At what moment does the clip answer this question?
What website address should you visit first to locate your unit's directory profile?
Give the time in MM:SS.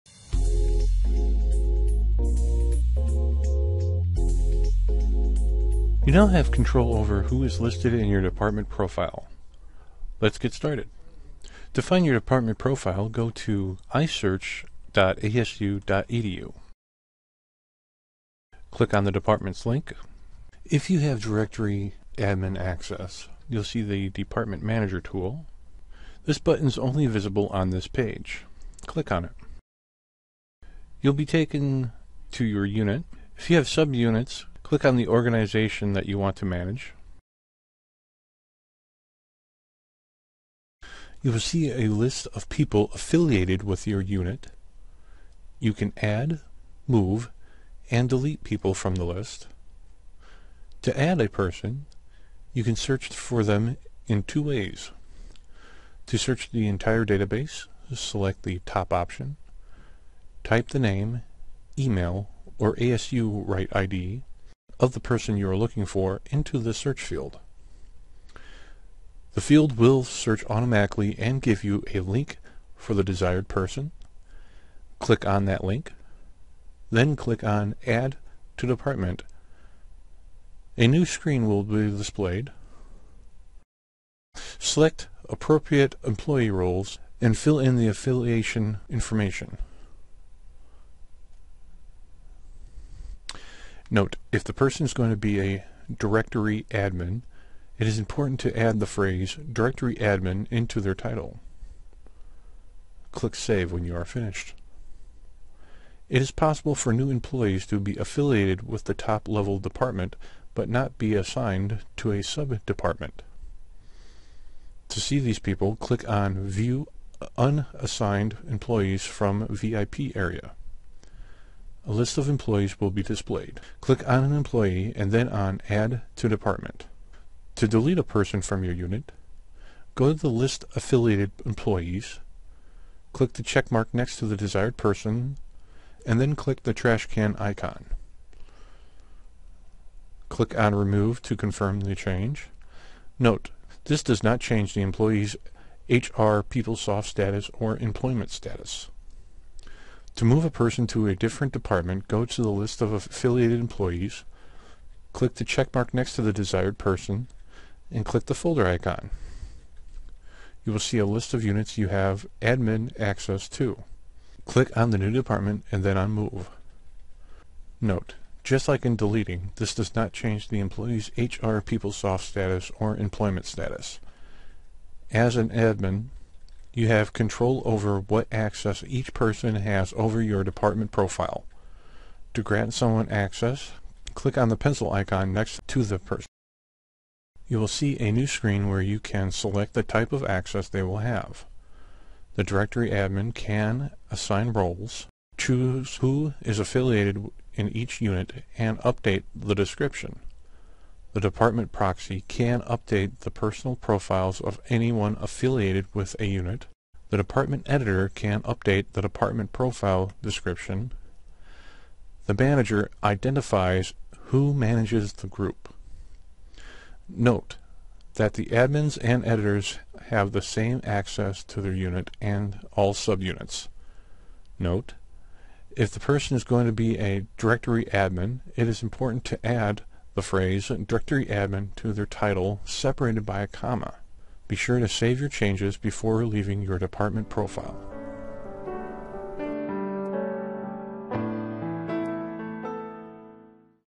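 00:13.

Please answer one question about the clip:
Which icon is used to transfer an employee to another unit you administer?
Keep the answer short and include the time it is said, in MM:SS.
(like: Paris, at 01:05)
folder icon, at 02:38.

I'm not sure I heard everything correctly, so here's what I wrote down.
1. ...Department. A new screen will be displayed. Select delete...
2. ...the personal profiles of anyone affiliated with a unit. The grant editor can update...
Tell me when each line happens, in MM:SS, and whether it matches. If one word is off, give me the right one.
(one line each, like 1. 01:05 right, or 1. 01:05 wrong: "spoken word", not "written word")
1. 01:18 wrong: "appropriate", not "delete"
2. 03:23 wrong: "department", not "grant".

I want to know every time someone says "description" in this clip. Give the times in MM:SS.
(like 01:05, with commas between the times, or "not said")
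03:19, 03:30.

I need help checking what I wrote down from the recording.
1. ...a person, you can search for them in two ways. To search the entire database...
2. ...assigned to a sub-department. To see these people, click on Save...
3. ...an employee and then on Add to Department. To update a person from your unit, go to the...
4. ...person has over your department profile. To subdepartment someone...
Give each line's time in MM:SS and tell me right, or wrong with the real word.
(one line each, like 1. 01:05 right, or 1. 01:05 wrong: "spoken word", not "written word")
1. 00:51 right
2. 01:51 wrong: "View", not "Save"
3. 02:04 wrong: "delete", not "update"
4. 02:59 wrong: "grant", not "subdepartment".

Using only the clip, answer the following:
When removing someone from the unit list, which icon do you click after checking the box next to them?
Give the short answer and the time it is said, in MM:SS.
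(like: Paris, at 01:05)
trash can icon, at 02:16.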